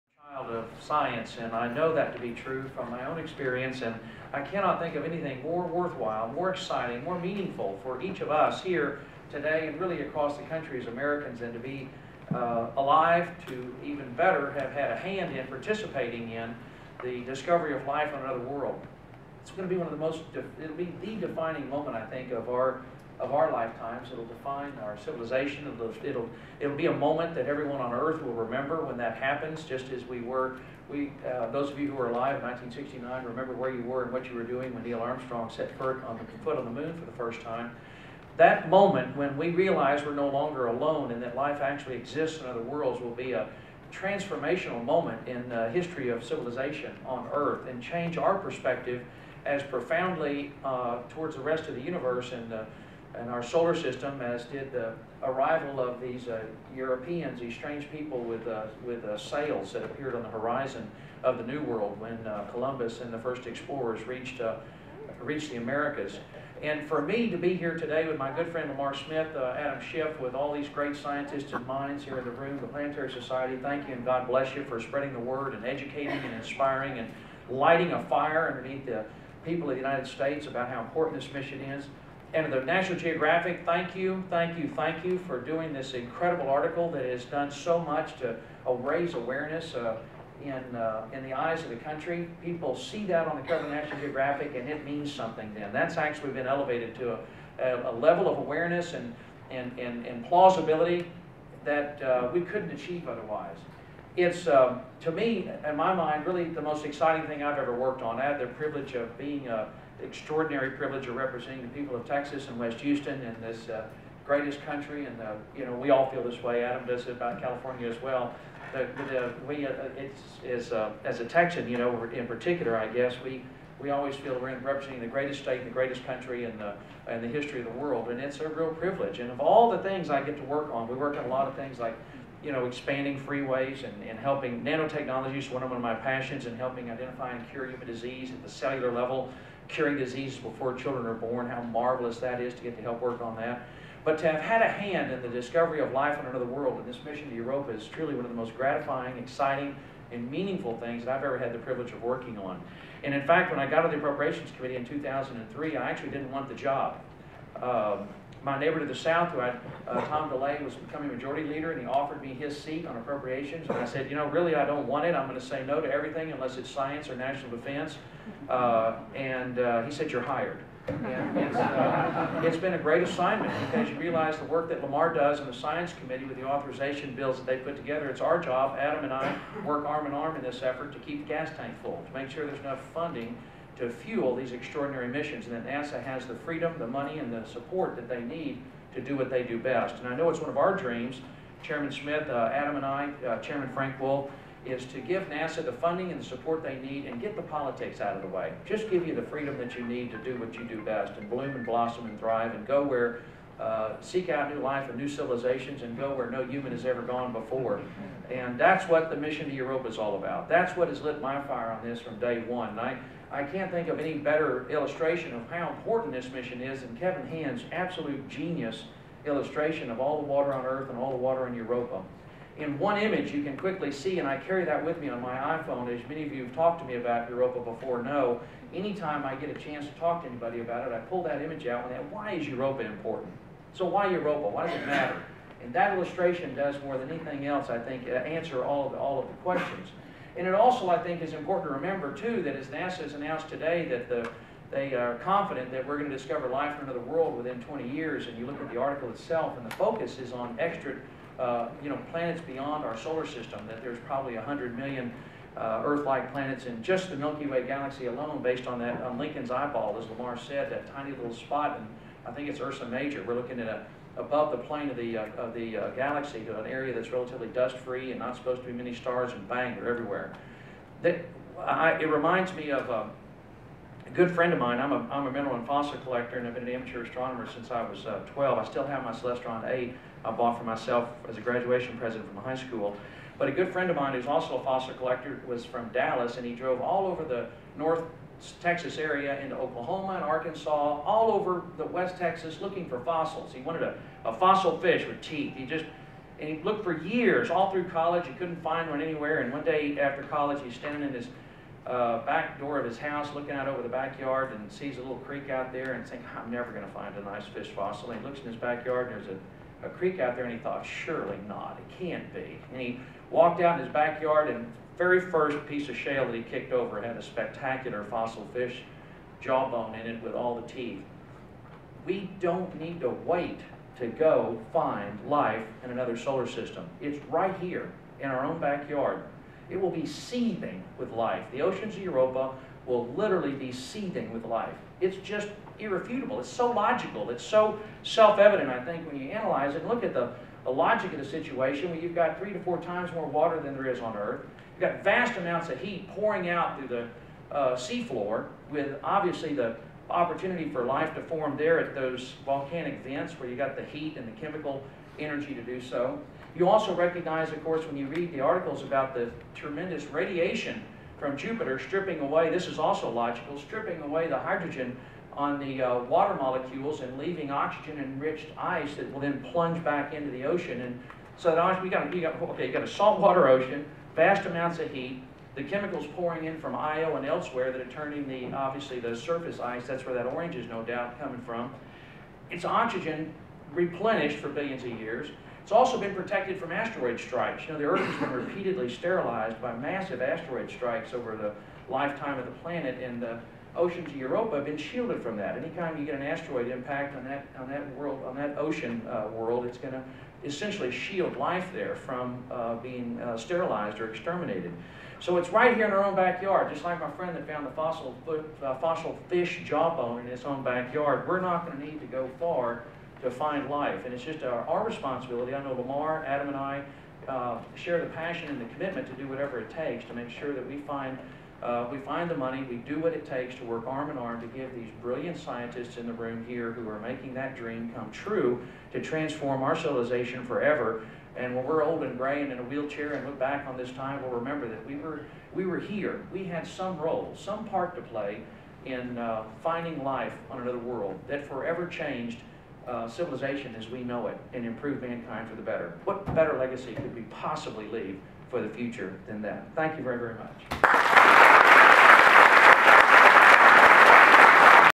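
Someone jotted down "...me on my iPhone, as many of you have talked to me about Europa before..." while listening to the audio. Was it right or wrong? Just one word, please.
right.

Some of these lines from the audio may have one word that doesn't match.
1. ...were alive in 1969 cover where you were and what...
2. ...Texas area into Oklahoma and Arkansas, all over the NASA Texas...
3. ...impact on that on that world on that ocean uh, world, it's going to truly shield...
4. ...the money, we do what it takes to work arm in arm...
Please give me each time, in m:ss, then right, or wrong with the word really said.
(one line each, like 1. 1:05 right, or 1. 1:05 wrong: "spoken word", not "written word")
1. 0:31 wrong: "remember", not "cover"
2. 4:48 wrong: "West", not "NASA"
3. 6:36 wrong: "essentially", not "truly"
4. 7:02 right.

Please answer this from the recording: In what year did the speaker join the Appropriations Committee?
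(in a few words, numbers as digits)
2003.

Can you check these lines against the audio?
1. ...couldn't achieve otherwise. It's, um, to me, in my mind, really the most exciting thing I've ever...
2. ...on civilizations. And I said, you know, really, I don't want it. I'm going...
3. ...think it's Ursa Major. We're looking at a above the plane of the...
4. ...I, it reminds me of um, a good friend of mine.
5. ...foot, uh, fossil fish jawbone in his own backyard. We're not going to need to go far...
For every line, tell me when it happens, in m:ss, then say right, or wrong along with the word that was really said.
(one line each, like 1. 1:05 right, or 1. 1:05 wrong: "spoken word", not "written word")
1. 1:42 right
2. 2:42 wrong: "appropriations", not "civilizations"
3. 4:22 right
4. 4:31 right
5. 6:48 right.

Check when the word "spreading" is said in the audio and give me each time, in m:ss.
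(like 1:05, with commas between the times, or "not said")
1:14.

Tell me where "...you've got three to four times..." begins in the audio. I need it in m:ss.
5:41.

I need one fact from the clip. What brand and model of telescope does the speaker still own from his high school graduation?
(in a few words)
Celestron 8.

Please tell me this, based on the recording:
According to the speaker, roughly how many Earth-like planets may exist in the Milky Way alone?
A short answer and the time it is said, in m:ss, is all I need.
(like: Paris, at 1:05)
100 million, at 4:14.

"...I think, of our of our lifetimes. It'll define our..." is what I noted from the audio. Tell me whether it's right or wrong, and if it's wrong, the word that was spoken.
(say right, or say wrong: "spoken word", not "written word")
right.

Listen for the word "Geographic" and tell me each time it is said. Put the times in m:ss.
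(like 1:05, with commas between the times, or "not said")
1:22, 1:33.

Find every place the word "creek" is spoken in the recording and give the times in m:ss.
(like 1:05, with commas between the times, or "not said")
5:05, 5:09.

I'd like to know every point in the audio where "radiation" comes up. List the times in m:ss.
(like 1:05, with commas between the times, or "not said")
6:00.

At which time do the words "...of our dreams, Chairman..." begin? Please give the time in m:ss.
3:10.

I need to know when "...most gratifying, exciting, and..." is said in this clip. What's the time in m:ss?
2:28.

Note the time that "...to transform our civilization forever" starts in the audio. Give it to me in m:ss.
7:08.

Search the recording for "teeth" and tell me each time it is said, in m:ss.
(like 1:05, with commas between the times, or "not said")
4:55, 5:20.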